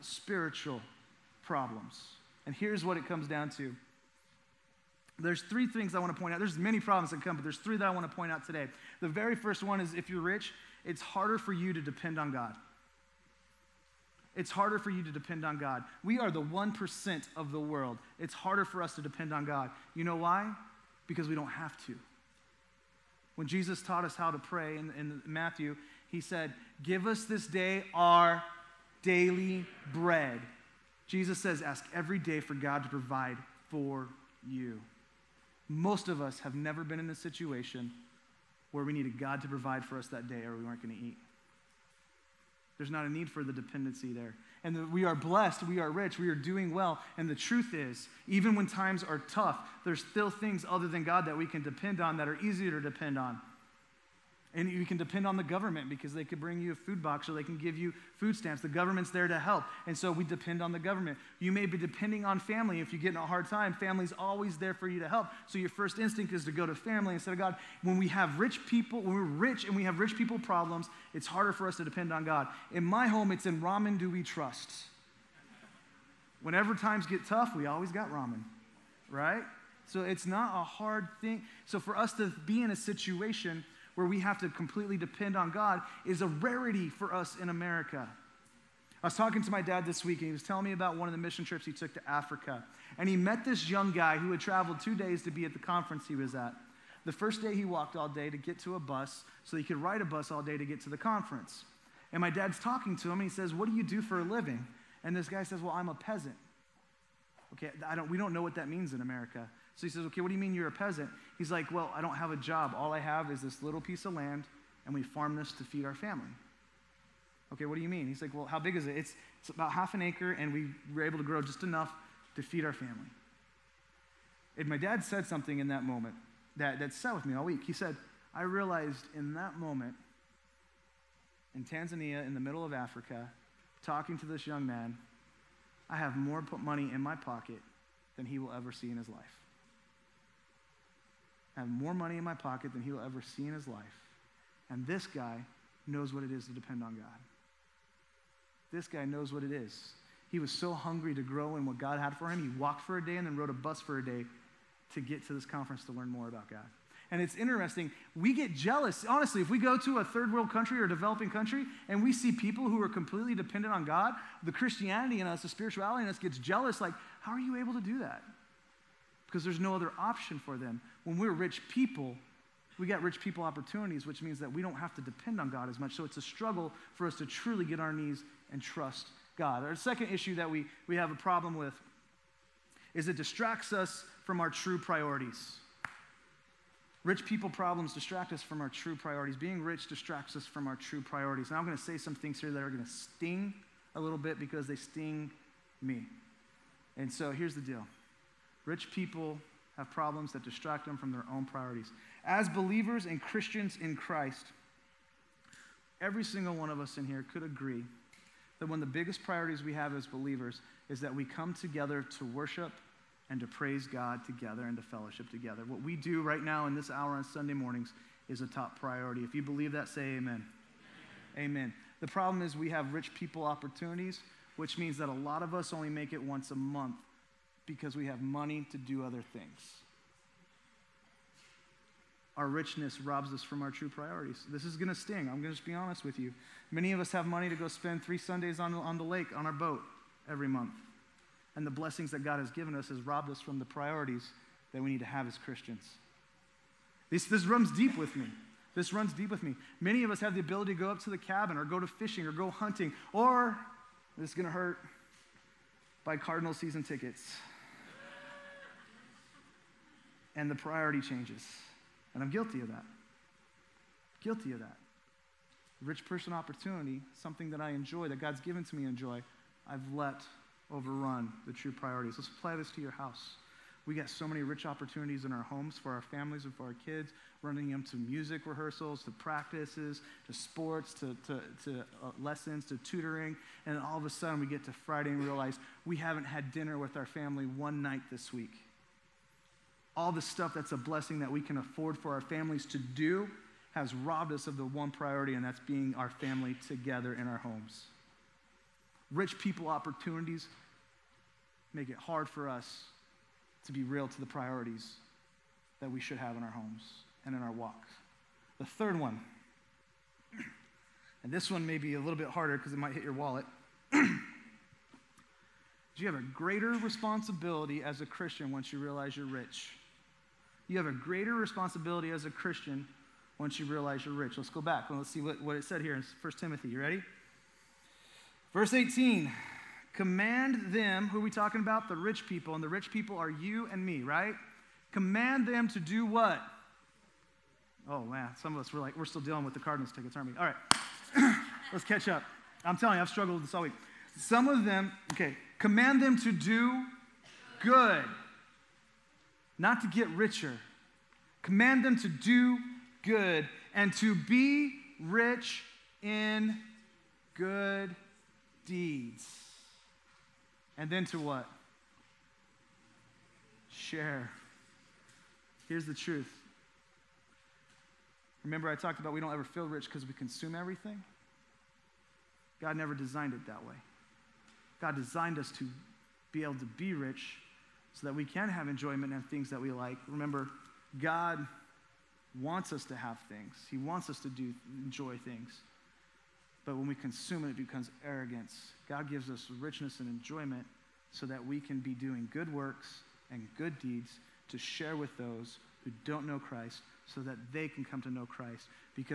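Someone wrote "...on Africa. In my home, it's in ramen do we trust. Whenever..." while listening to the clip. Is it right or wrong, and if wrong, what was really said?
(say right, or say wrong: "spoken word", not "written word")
wrong: "God", not "Africa".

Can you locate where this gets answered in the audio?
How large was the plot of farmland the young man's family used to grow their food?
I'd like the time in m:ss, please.
1:59.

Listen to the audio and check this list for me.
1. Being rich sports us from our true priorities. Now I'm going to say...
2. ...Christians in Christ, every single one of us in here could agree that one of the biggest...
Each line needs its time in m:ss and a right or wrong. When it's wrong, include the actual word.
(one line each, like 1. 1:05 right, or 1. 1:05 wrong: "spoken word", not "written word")
1. 3:09 wrong: "distracts", not "sports"
2. 3:23 right.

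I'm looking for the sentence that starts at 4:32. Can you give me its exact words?
Let's apply this to your house.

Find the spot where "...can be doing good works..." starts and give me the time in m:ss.
6:31.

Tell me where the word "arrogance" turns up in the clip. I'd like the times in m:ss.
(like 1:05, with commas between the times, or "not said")
6:28.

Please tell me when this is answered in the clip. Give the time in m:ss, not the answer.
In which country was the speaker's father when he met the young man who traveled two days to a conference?
2:11.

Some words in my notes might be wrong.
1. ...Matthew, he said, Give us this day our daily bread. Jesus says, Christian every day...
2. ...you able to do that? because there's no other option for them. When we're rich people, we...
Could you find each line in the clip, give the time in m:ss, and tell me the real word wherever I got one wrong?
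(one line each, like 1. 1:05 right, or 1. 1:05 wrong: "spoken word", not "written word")
1. 0:25 wrong: "Ask", not "Christian"
2. 2:47 right.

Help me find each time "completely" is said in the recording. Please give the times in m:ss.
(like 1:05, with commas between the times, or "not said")
1:24, 2:42.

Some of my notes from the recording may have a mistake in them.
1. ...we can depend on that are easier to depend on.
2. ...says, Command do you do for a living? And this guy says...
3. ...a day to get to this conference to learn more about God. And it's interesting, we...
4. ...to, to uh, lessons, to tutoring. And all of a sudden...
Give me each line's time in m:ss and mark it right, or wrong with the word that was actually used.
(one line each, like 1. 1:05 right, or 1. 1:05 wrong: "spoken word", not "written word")
1. 0:51 right
2. 1:43 wrong: "What", not "Command"
3. 2:33 right
4. 4:41 right.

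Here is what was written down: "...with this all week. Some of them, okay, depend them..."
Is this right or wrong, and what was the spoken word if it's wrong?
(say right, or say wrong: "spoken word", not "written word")
wrong: "command", not "depend".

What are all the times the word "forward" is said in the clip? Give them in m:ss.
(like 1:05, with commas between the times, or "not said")
not said.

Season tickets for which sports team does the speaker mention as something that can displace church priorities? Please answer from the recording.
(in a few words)
Cardinals.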